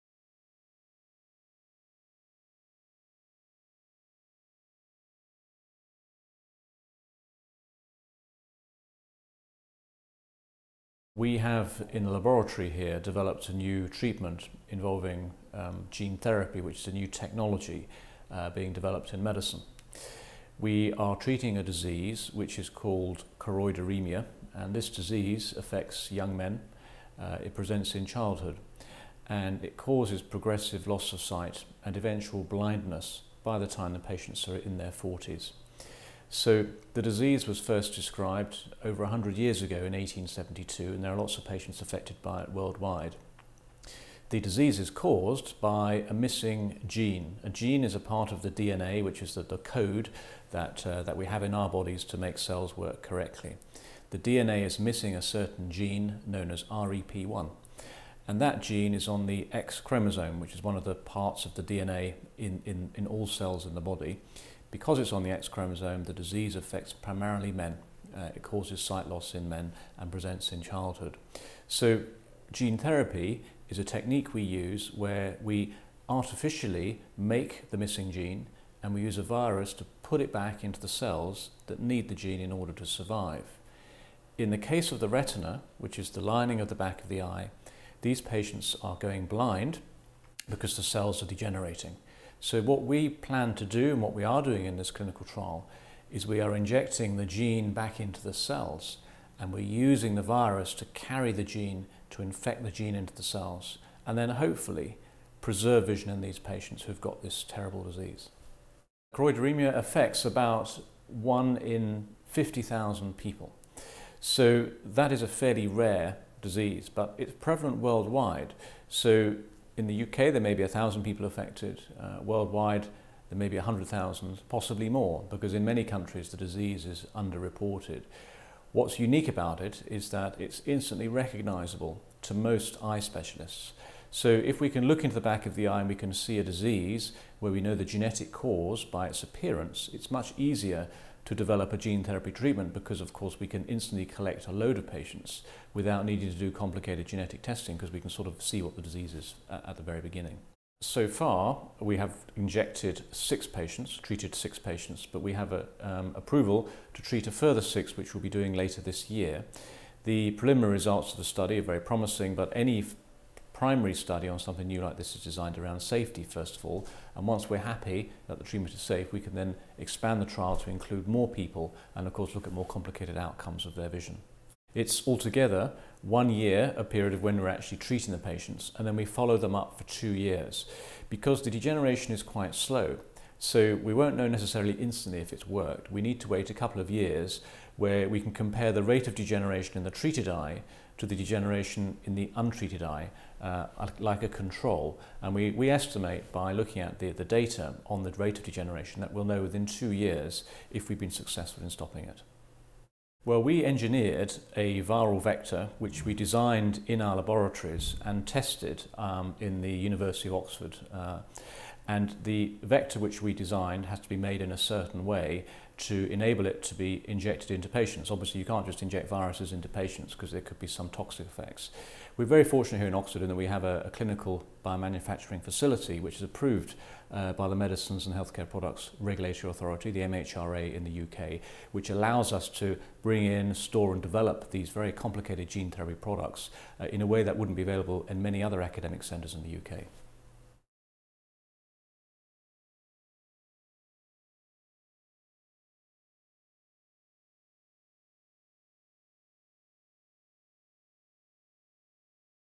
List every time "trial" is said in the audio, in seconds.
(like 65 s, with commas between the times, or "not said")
95 s, 170 s.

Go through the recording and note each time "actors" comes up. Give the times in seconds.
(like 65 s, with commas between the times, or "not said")
not said.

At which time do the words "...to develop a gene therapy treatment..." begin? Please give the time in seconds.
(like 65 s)
141 s.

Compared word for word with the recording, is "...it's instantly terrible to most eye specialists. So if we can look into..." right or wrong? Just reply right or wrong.
wrong.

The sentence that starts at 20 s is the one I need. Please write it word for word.
We are treating a disease which is called choroideremia, and this disease affects young men.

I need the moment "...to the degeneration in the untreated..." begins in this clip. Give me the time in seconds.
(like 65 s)
190 s.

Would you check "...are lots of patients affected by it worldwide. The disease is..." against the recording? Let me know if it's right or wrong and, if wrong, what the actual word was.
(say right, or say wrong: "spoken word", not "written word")
right.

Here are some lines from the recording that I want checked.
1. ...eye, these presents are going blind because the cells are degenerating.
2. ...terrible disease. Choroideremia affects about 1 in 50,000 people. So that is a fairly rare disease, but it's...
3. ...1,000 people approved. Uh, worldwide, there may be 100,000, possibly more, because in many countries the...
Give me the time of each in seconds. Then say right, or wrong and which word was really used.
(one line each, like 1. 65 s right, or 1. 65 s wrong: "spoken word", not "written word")
1. 87 s wrong: "patients", not "presents"
2. 107 s right
3. 120 s wrong: "affected", not "approved".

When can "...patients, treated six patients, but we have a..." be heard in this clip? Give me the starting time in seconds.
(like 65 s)
153 s.